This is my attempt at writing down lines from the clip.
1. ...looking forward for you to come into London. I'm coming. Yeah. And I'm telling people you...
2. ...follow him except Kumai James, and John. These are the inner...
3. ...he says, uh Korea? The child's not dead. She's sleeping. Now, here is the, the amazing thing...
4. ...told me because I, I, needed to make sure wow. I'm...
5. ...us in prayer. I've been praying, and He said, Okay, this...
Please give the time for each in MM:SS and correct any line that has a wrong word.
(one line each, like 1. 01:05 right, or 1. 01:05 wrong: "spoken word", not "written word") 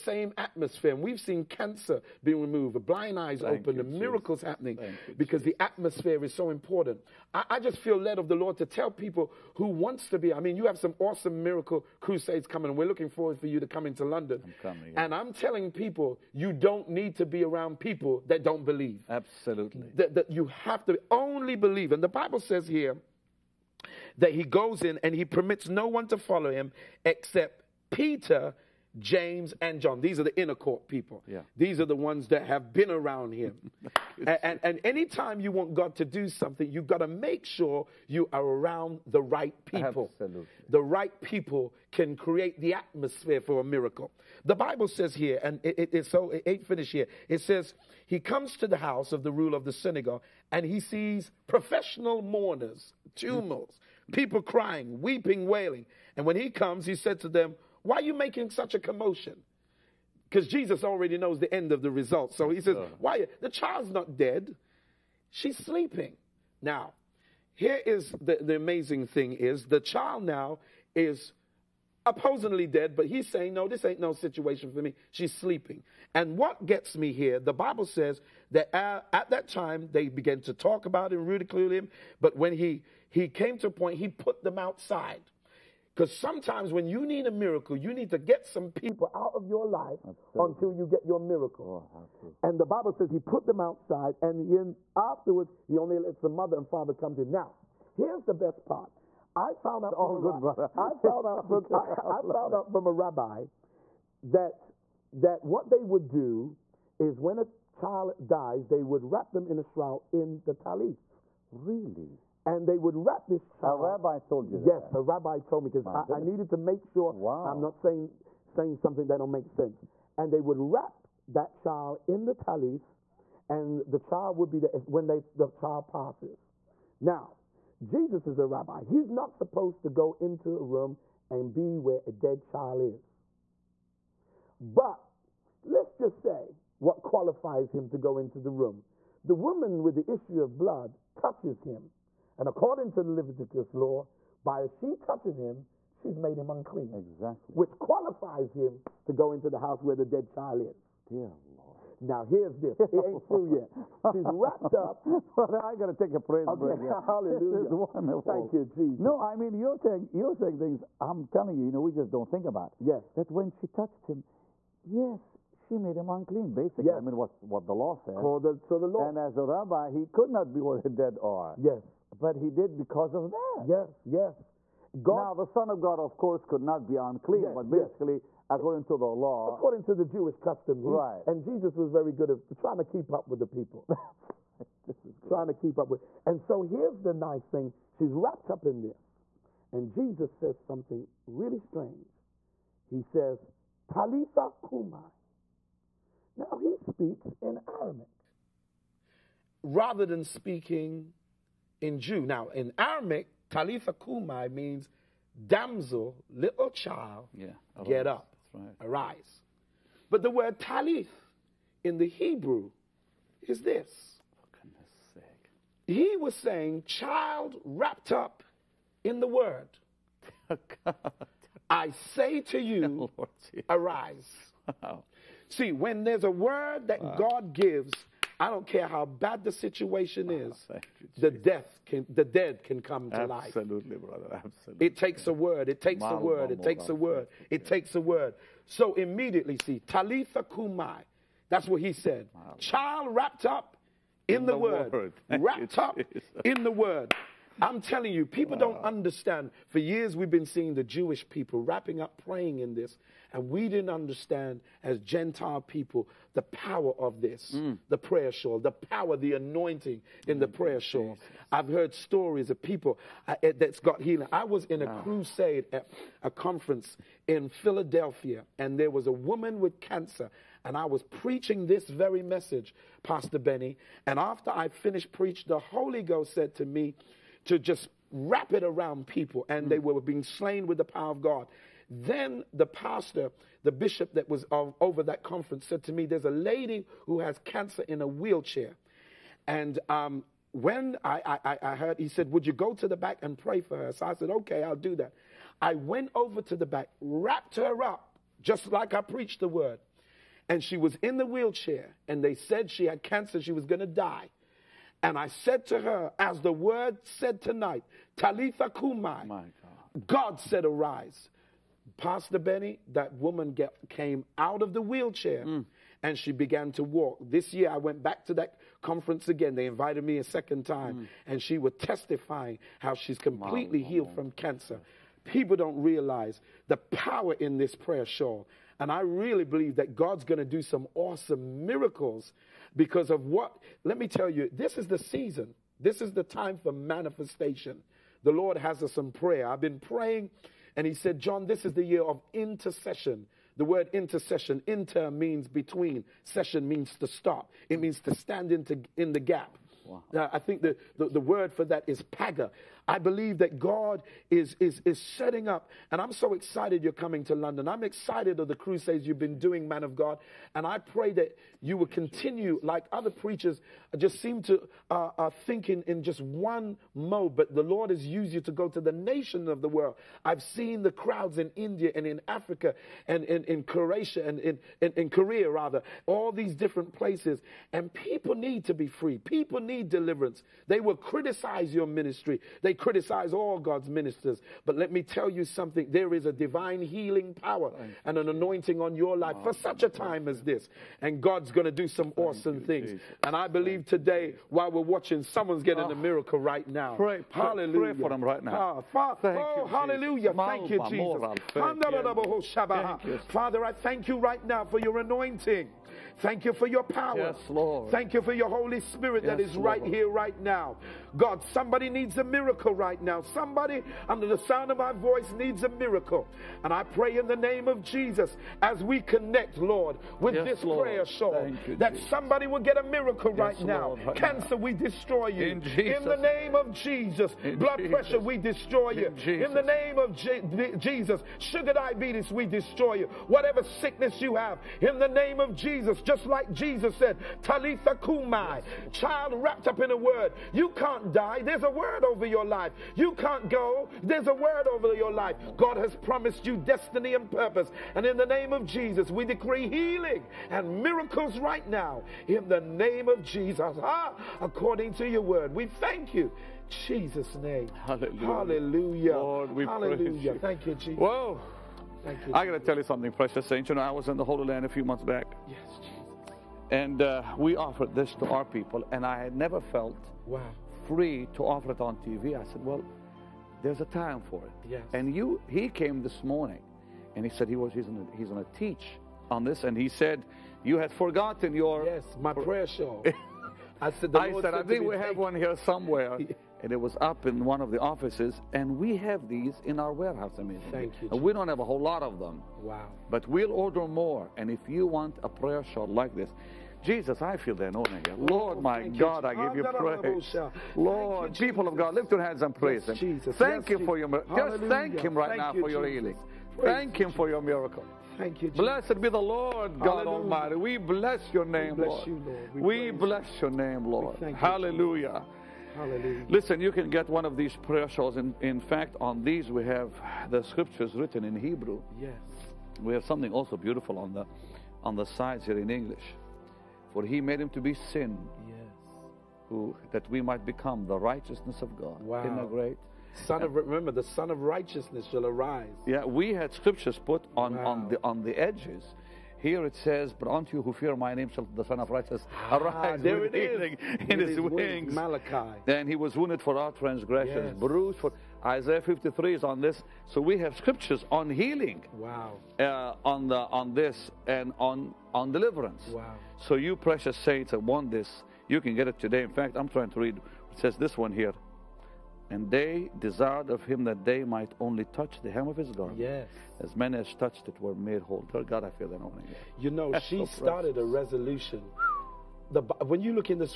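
1. 00:12 right
2. 00:26 wrong: "Peter", not "Kumai"
3. 01:02 wrong: "Why", not "Korea"
4. 01:55 right
5. 05:38 wrong: "John", not "Okay".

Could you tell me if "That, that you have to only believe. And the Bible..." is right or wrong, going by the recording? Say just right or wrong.
right.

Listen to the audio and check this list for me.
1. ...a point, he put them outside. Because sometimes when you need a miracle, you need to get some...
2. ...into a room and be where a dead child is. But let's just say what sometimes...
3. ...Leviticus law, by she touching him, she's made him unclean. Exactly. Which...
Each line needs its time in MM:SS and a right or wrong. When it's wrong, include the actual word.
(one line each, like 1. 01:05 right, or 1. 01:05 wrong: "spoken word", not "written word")
1. 01:23 right
2. 02:10 wrong: "qualifies", not "sometimes"
3. 02:23 right.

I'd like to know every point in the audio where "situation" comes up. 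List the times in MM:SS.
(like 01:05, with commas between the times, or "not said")
01:14, 03:49.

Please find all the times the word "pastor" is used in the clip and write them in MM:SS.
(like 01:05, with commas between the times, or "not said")
04:33, 04:42, 05:11.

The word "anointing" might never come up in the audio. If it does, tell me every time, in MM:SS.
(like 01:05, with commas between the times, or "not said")
04:19, 06:28, 06:44, 08:17.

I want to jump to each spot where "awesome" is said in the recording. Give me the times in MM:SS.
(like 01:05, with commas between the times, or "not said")
00:10, 05:30, 06:32.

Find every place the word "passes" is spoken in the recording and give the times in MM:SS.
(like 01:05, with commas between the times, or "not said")
02:05.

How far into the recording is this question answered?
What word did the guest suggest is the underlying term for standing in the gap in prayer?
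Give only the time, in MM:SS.
05:52.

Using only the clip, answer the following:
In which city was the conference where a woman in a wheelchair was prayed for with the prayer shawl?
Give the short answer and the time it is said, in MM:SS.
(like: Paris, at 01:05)
Philadelphia, at 04:27.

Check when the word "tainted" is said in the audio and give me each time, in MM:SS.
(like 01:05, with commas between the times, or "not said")
not said.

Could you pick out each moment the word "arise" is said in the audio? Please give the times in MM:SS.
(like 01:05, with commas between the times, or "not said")
03:28, 03:43, 05:10, 08:55, 09:02.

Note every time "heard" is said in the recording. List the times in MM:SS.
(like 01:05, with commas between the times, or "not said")
04:21, 04:51.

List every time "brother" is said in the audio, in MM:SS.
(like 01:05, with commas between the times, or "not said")
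02:35, 03:53.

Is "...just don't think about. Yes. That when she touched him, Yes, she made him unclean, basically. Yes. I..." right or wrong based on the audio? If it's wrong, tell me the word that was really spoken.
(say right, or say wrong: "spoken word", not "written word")
right.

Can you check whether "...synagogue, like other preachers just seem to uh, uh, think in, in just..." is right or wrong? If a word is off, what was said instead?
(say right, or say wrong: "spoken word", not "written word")
wrong: "continue", not "synagogue".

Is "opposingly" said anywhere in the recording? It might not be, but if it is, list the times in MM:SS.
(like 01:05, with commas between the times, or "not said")
01:12.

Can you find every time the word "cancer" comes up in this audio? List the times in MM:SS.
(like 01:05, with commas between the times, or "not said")
00:01, 04:29, 04:47, 05:03, 05:24, 07:04.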